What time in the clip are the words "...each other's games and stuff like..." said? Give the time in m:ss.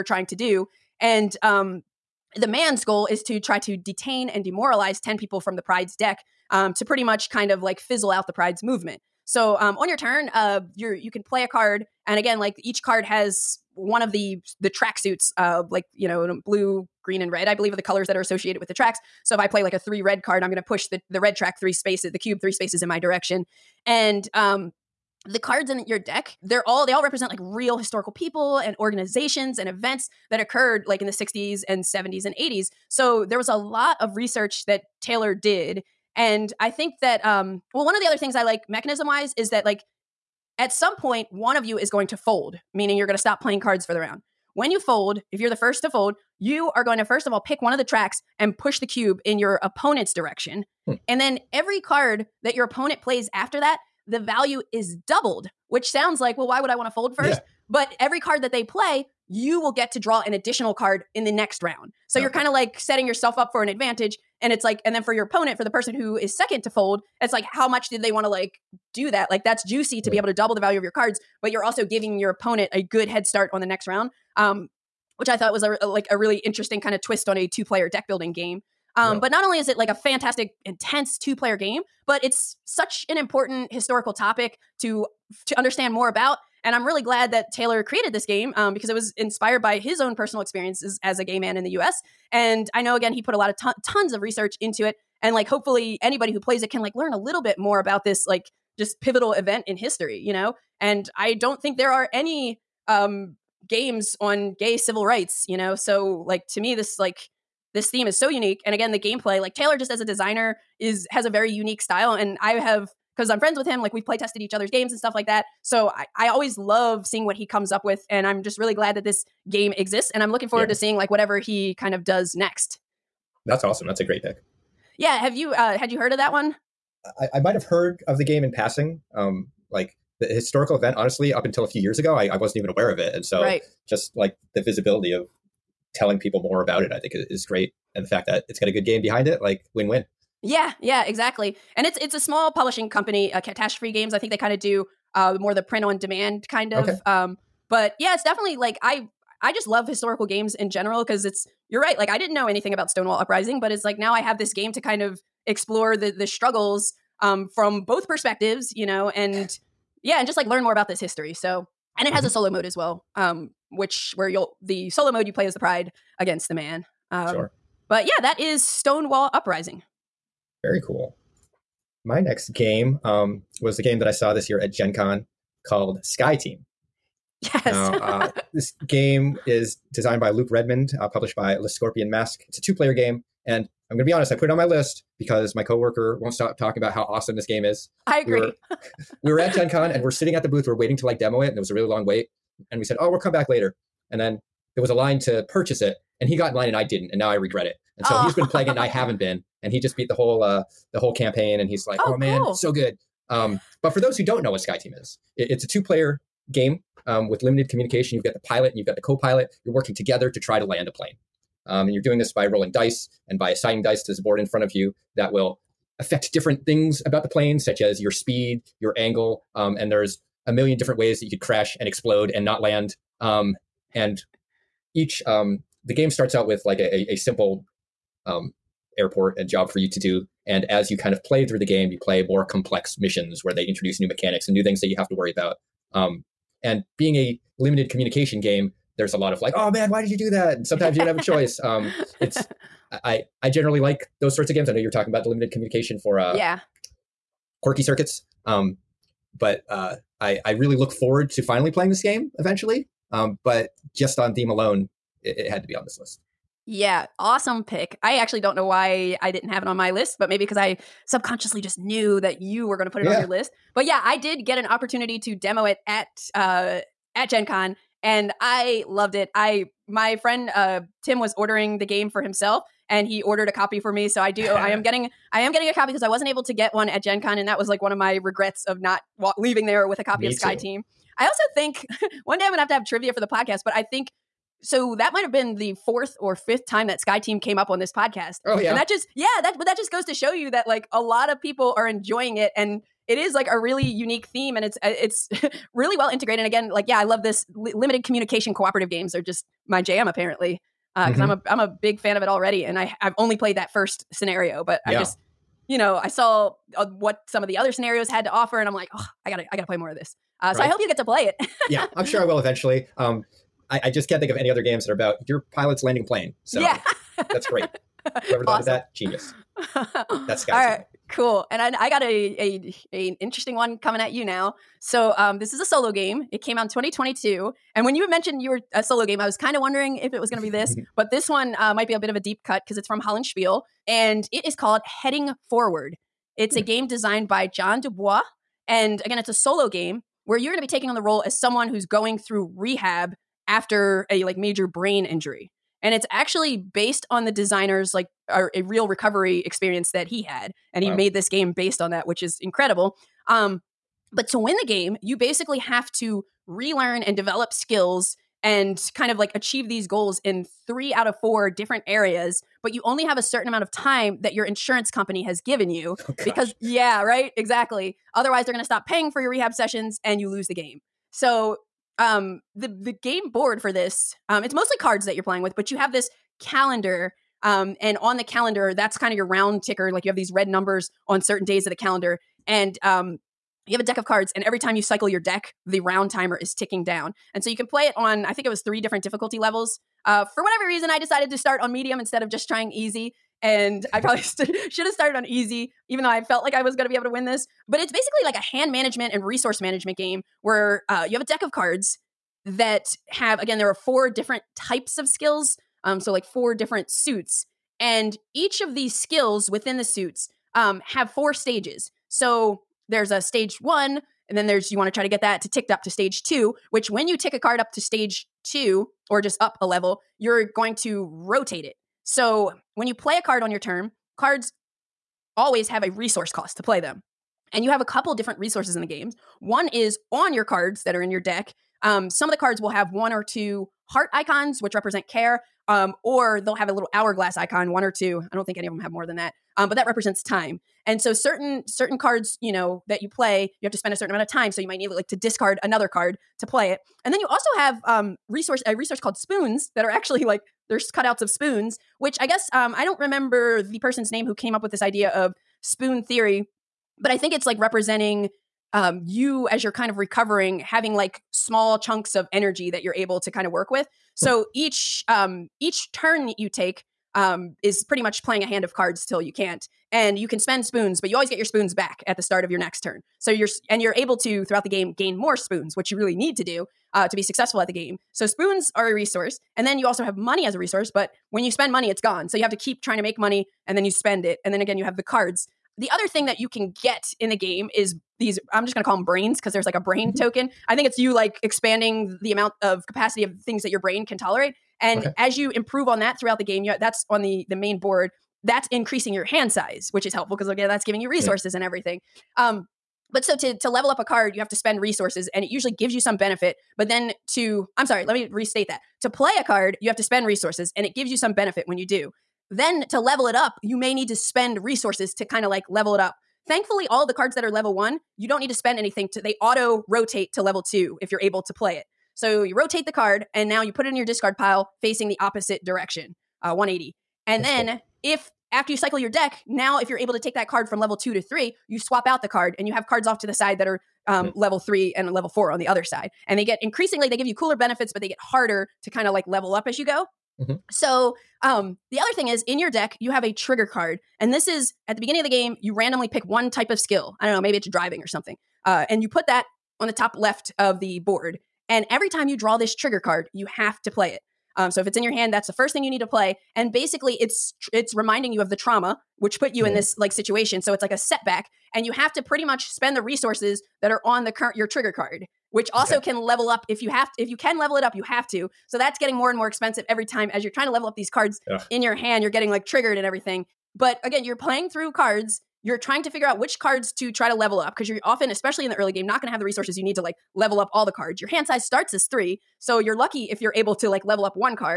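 1:54.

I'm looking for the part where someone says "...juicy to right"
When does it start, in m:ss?
1:09.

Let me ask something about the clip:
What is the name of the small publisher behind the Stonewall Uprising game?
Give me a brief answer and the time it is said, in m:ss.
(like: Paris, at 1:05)
Catastrophe Games, at 2:23.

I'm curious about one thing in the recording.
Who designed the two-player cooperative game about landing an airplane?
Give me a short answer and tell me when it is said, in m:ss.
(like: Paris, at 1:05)
Luke Redmond, at 3:00.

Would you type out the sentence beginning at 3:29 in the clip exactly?
You're working together to try to land a plane.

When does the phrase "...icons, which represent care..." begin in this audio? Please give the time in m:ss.
7:14.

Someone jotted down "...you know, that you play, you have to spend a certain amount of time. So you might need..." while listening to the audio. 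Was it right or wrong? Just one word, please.
right.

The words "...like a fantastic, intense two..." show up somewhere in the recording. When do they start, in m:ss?
1:19.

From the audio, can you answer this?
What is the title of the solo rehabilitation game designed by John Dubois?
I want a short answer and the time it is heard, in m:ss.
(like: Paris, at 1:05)
Heading Forward, at 5:35.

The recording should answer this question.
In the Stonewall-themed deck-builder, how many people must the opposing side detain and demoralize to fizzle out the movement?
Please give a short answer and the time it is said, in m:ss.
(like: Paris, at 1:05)
10, at 0:04.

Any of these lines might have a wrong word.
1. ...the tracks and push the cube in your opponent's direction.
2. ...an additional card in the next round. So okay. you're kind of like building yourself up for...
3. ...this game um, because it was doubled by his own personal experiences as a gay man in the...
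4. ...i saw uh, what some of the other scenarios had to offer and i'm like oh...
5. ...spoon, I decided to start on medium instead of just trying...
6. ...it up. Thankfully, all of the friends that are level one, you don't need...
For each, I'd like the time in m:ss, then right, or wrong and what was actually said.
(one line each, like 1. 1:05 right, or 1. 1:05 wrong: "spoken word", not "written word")
1. 0:47 right
2. 1:00 wrong: "setting", not "building"
3. 1:28 wrong: "inspired", not "doubled"
4. 5:06 right
5. 6:30 wrong: "reason", not "spoon"
6. 8:35 wrong: "cards", not "friends".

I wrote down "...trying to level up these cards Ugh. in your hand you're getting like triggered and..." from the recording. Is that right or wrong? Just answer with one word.
right.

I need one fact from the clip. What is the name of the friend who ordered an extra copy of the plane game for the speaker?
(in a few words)
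Tim.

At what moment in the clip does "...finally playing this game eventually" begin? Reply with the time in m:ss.
4:11.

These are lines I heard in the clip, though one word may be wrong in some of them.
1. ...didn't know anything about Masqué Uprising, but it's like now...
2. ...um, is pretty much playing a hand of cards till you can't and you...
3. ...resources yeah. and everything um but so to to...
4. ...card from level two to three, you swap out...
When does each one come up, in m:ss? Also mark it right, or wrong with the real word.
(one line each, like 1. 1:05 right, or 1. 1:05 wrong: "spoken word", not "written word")
1. 2:32 wrong: "Stonewall", not "Masqué"
2. 7:47 right
3. 8:21 right
4. 8:50 right.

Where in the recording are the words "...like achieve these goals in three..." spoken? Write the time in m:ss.
5:59.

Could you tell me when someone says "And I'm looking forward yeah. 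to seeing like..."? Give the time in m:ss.
2:00.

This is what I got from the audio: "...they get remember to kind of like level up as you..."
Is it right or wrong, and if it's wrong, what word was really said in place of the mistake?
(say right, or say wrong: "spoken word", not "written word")
wrong: "harder", not "remember".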